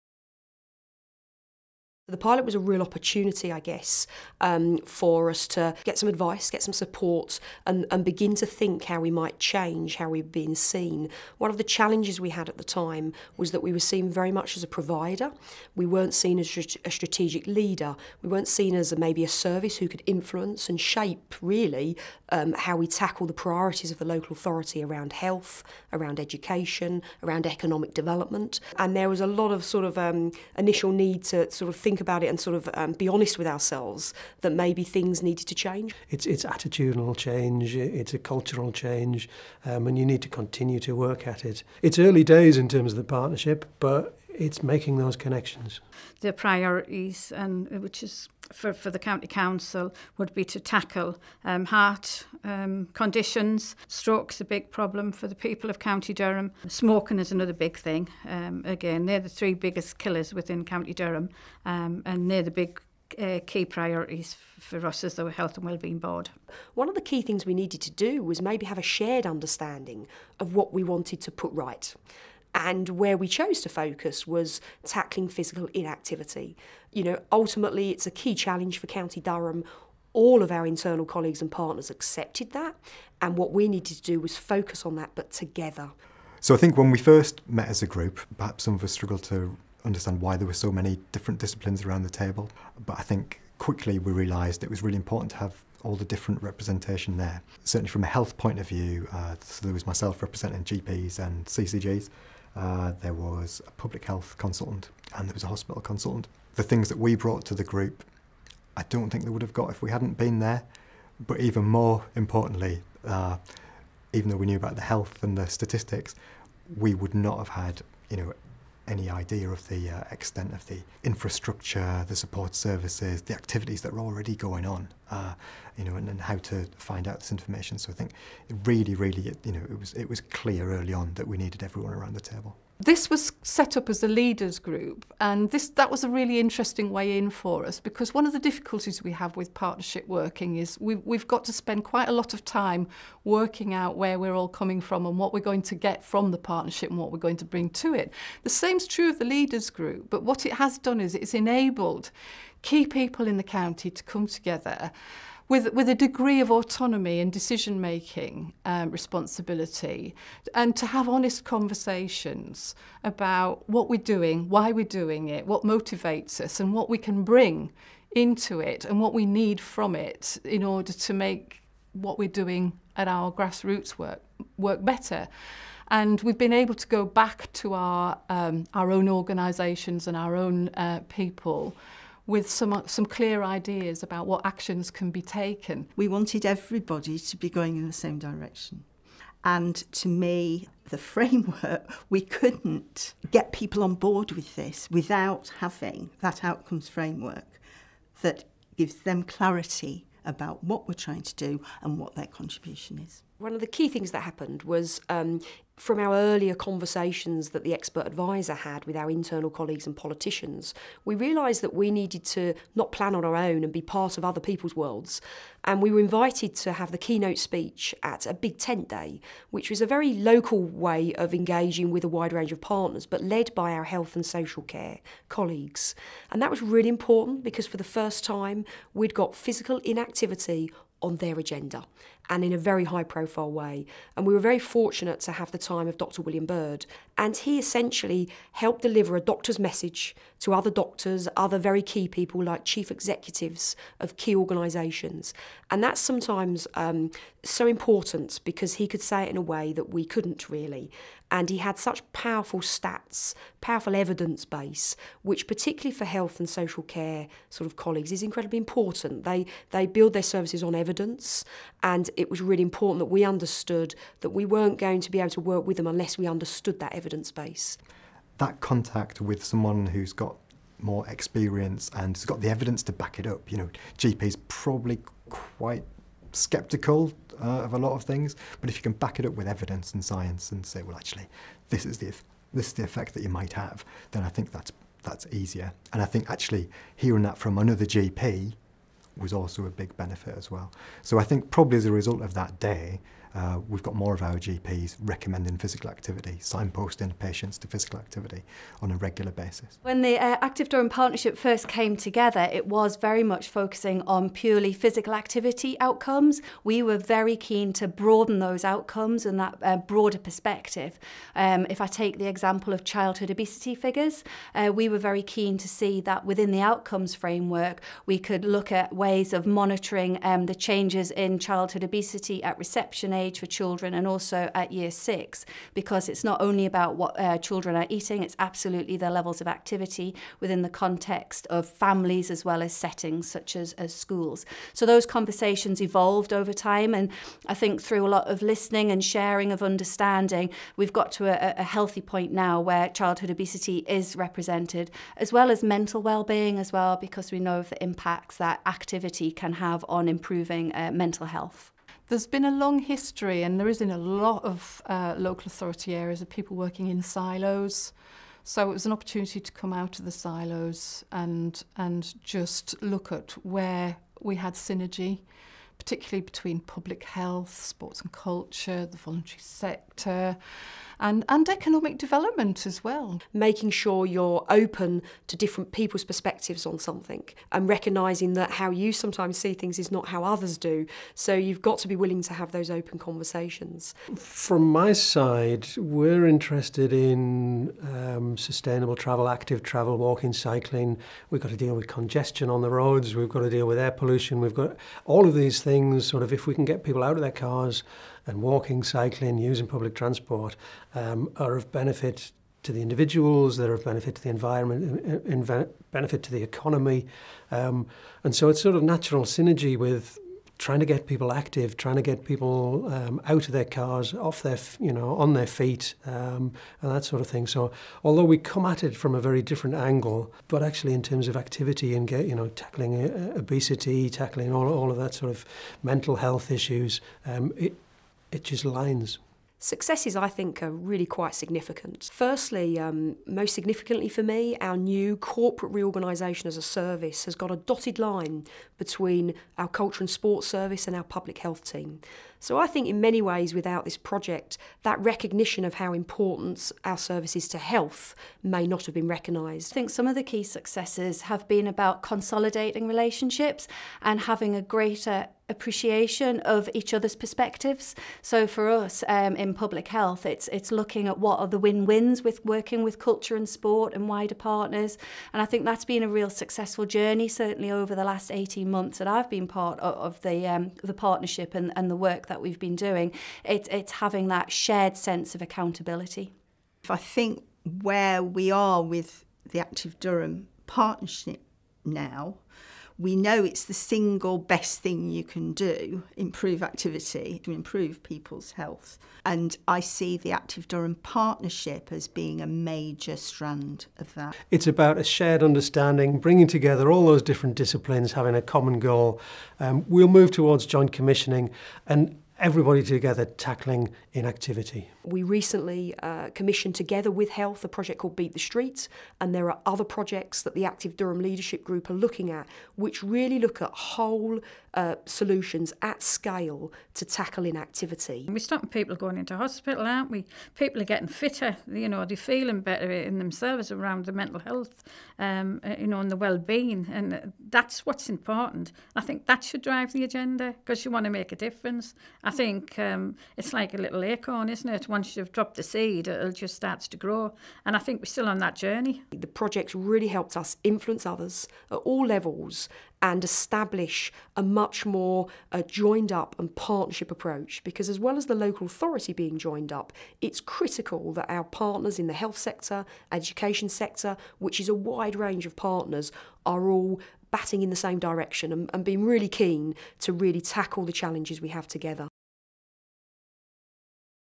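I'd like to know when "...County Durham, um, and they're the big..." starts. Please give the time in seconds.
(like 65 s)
60 s.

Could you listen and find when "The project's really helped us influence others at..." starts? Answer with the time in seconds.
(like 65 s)
539 s.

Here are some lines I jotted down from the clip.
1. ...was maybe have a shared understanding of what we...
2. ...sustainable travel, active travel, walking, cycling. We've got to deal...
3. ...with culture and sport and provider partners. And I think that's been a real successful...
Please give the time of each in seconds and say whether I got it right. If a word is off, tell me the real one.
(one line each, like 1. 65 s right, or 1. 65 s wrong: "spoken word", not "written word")
1. 68 s right
2. 388 s right
3. 462 s wrong: "wider", not "provider".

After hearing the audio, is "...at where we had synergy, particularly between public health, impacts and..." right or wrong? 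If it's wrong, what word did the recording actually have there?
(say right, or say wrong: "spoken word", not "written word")
wrong: "sports", not "impacts".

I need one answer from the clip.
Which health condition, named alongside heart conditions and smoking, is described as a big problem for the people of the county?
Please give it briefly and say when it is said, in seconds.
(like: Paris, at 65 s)
Stroke, at 53 s.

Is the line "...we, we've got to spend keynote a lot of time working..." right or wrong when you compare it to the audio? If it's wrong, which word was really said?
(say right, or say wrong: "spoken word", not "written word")
wrong: "quite", not "keynote".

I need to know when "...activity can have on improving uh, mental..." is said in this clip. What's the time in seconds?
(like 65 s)
348 s.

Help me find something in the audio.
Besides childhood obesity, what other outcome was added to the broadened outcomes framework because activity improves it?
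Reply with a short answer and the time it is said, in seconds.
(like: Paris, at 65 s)
Mental well-being, at 345 s.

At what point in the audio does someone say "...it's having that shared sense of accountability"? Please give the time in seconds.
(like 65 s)
473 s.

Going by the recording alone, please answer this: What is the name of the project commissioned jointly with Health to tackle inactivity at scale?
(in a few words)
Beat the Streets.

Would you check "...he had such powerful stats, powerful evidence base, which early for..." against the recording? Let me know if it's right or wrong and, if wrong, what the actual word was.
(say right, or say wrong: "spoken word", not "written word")
wrong: "particularly", not "early".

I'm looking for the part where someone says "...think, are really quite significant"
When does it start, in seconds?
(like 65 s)
430 s.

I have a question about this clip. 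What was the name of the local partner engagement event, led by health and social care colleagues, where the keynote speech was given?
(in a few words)
Big tent day.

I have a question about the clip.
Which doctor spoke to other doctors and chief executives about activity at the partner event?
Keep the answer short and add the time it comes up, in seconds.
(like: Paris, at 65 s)
Dr. William Bird, at 235 s.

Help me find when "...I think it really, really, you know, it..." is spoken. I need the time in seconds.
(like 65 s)
127 s.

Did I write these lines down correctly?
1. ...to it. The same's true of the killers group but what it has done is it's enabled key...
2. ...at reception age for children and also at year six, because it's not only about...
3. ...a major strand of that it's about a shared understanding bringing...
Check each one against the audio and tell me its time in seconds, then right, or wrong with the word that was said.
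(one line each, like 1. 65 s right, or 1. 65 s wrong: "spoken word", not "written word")
1. 147 s wrong: "leaders", not "killers"
2. 322 s right
3. 492 s right.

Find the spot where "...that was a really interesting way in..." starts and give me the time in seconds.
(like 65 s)
135 s.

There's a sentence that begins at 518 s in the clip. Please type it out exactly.
We're stopping people going into hospital, aren't we?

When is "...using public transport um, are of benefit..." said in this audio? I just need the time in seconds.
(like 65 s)
399 s.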